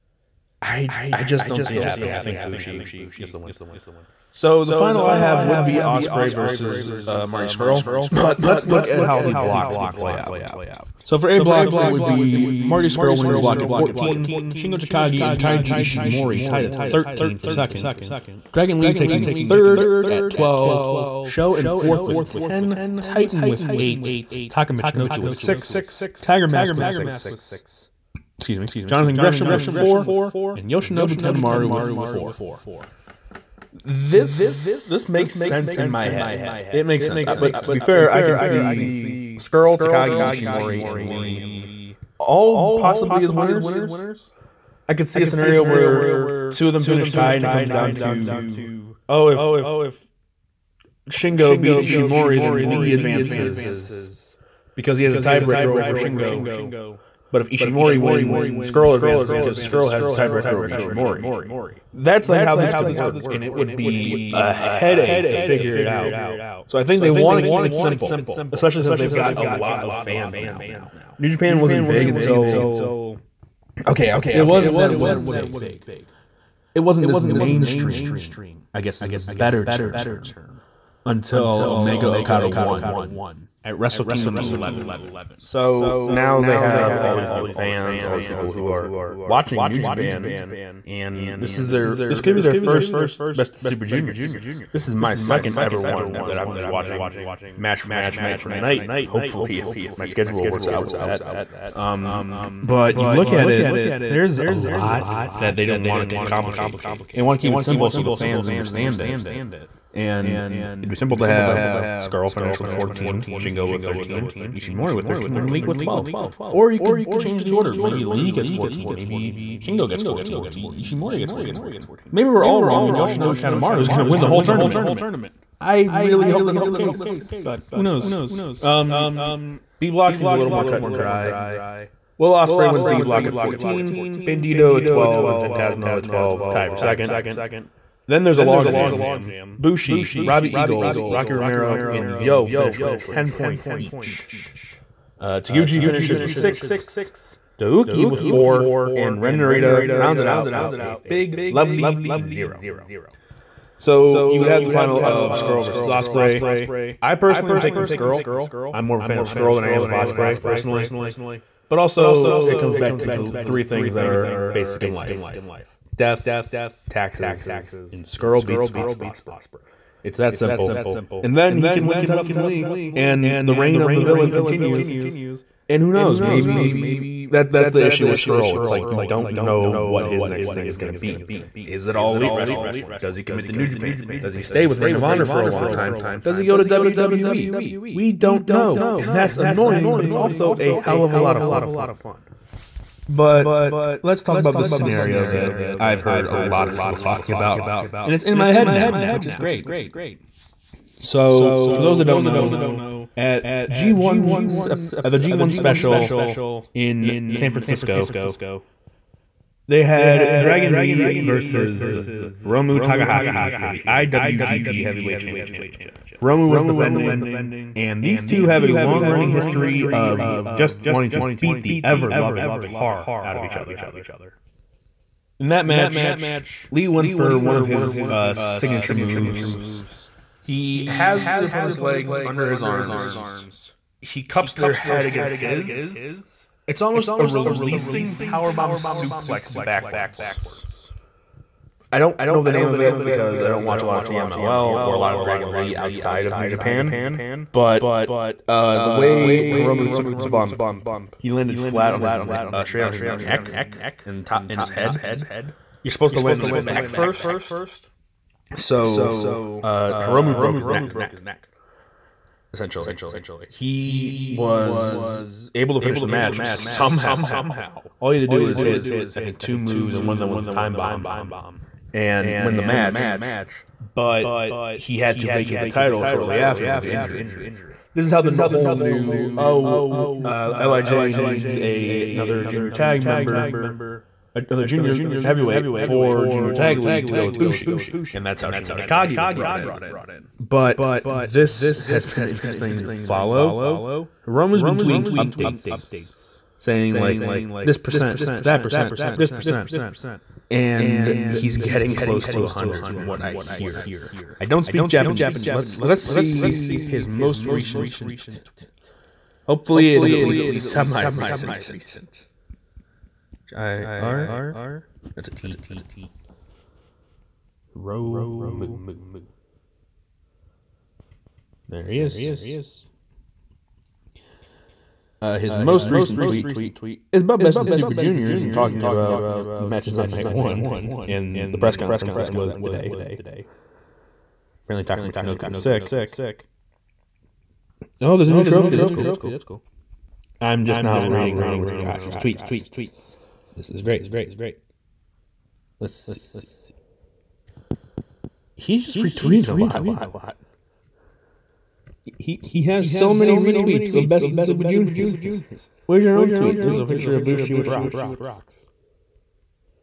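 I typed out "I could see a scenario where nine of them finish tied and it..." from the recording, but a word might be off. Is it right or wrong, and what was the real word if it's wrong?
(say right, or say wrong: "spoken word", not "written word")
wrong: "two", not "nine".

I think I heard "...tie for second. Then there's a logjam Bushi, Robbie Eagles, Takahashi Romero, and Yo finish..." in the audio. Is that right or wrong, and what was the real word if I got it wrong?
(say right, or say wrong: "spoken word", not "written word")
wrong: "Rocky", not "Takahashi".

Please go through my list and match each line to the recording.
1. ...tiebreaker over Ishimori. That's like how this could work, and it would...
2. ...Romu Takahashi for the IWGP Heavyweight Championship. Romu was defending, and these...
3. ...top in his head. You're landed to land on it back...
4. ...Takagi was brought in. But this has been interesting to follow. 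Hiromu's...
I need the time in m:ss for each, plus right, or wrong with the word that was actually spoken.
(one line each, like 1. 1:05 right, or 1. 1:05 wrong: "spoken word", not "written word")
1. 1:00 right
2. 3:32 right
3. 4:14 wrong: "supposed", not "landed"
4. 4:48 right.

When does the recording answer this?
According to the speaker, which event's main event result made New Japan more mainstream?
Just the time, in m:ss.
1:23.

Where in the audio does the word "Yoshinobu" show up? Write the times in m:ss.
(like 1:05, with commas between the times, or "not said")
0:30, 2:02.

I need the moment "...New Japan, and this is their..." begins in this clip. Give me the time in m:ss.
1:29.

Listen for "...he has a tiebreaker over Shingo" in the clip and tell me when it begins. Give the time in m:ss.
0:54.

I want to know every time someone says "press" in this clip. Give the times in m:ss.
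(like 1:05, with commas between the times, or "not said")
5:31.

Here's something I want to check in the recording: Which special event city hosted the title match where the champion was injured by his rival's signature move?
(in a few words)
San Francisco.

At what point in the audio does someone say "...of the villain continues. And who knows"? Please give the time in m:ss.
2:53.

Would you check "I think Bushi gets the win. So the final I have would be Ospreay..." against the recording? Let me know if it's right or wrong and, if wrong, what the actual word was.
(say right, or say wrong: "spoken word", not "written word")
right.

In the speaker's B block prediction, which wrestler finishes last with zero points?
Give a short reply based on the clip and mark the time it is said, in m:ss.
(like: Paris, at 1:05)
Ren Narita, at 2:29.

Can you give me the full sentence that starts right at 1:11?
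New Japan wasn't big until okay, it wasn't that it wasn't big.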